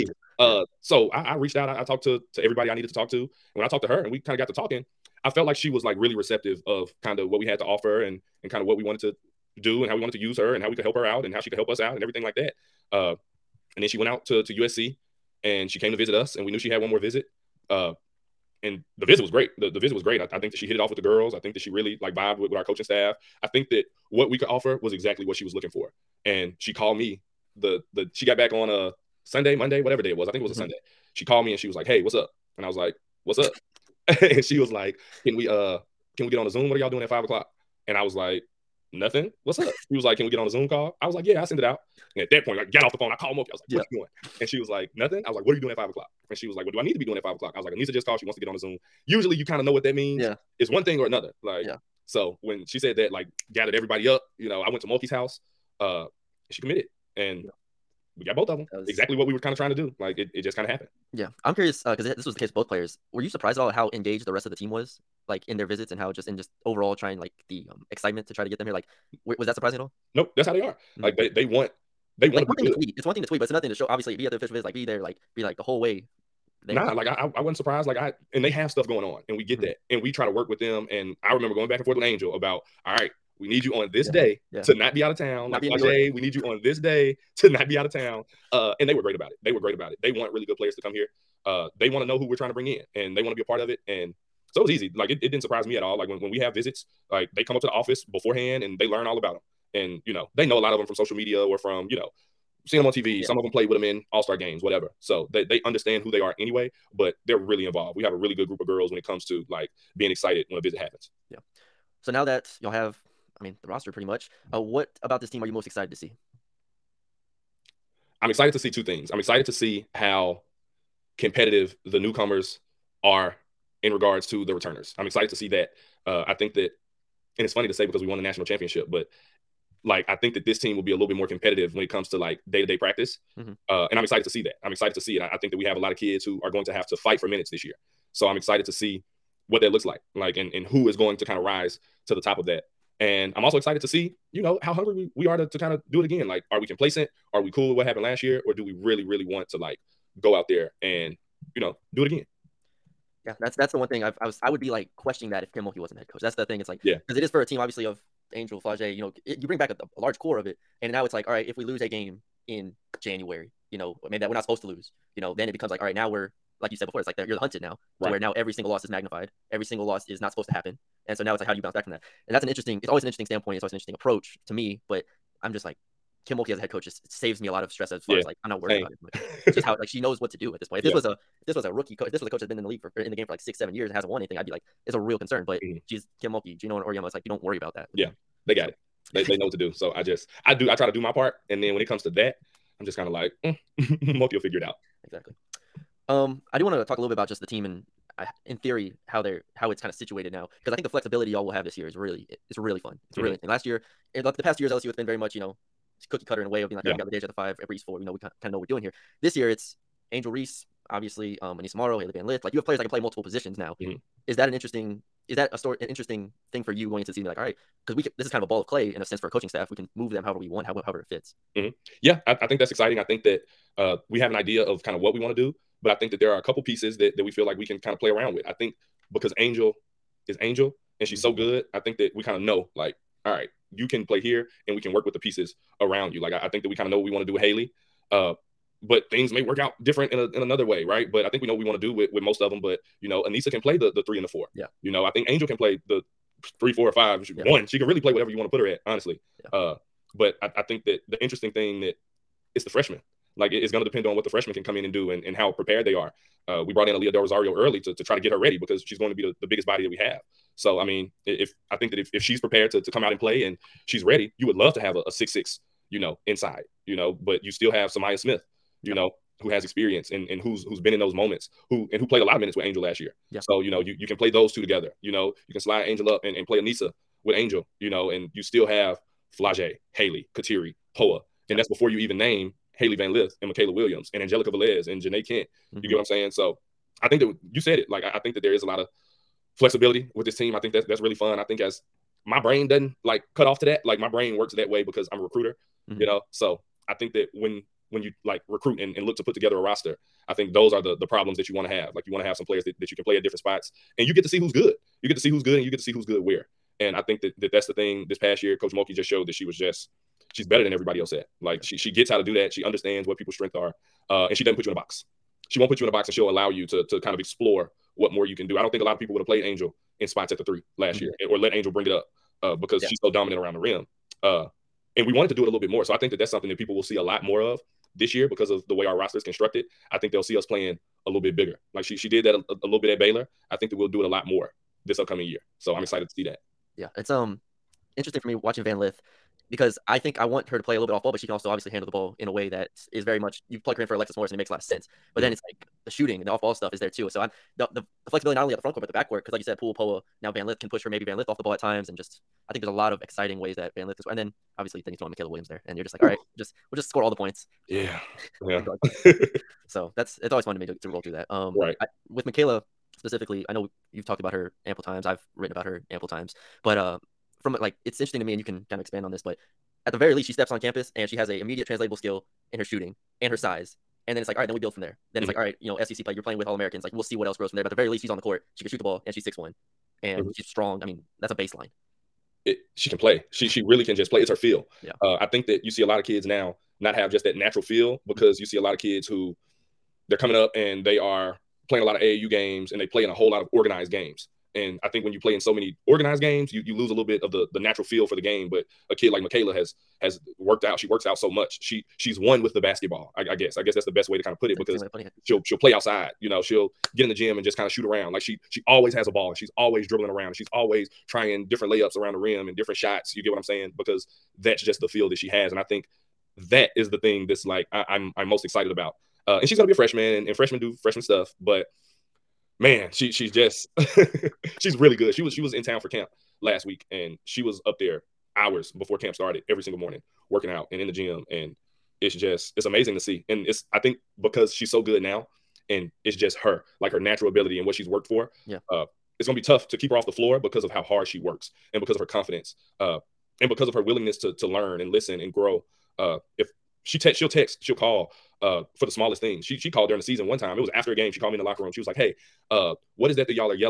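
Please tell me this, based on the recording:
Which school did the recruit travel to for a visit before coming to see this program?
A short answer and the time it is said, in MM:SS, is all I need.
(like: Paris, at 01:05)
USC, at 00:14.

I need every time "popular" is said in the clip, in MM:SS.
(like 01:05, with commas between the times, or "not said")
not said.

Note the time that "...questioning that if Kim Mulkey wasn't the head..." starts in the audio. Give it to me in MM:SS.
02:34.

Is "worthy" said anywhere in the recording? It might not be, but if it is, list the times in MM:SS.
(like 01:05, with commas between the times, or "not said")
not said.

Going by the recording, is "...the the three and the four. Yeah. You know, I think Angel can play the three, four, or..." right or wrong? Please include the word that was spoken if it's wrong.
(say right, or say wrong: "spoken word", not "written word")
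right.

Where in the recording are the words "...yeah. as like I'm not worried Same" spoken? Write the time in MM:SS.
02:58.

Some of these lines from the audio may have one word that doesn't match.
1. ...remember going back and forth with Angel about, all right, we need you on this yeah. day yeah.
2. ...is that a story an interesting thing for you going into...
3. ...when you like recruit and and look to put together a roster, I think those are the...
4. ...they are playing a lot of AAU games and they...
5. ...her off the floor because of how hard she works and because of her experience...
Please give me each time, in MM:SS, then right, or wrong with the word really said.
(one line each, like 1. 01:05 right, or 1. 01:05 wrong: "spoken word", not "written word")
1. 01:21 right
2. 03:35 right
3. 04:57 right
4. 06:30 right
5. 07:19 wrong: "confidence", not "experience".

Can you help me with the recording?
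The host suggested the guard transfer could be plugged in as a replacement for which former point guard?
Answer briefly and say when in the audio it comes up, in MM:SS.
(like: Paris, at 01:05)
Alexis Morris, at 05:43.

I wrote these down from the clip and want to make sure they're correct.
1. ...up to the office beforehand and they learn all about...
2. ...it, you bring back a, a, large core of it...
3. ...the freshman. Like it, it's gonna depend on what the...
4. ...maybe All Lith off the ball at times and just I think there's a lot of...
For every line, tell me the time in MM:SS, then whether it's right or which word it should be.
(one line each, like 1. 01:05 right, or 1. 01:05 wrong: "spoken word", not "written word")
1. 01:37 right
2. 02:39 right
3. 04:12 right
4. 05:50 wrong: "Van", not "All".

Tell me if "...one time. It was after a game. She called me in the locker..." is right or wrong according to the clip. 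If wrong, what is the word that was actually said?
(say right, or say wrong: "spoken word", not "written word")
right.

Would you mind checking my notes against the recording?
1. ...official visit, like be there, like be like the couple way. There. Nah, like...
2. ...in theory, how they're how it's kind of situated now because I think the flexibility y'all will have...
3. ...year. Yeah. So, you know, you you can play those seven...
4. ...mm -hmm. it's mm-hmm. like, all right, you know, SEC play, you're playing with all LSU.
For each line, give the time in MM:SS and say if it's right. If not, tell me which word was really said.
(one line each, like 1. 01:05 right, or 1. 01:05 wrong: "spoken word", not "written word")
1. 01:14 wrong: "whole", not "couple"
2. 03:18 right
3. 04:33 wrong: "two", not "seven"
4. 06:15 wrong: "Americans", not "LSU".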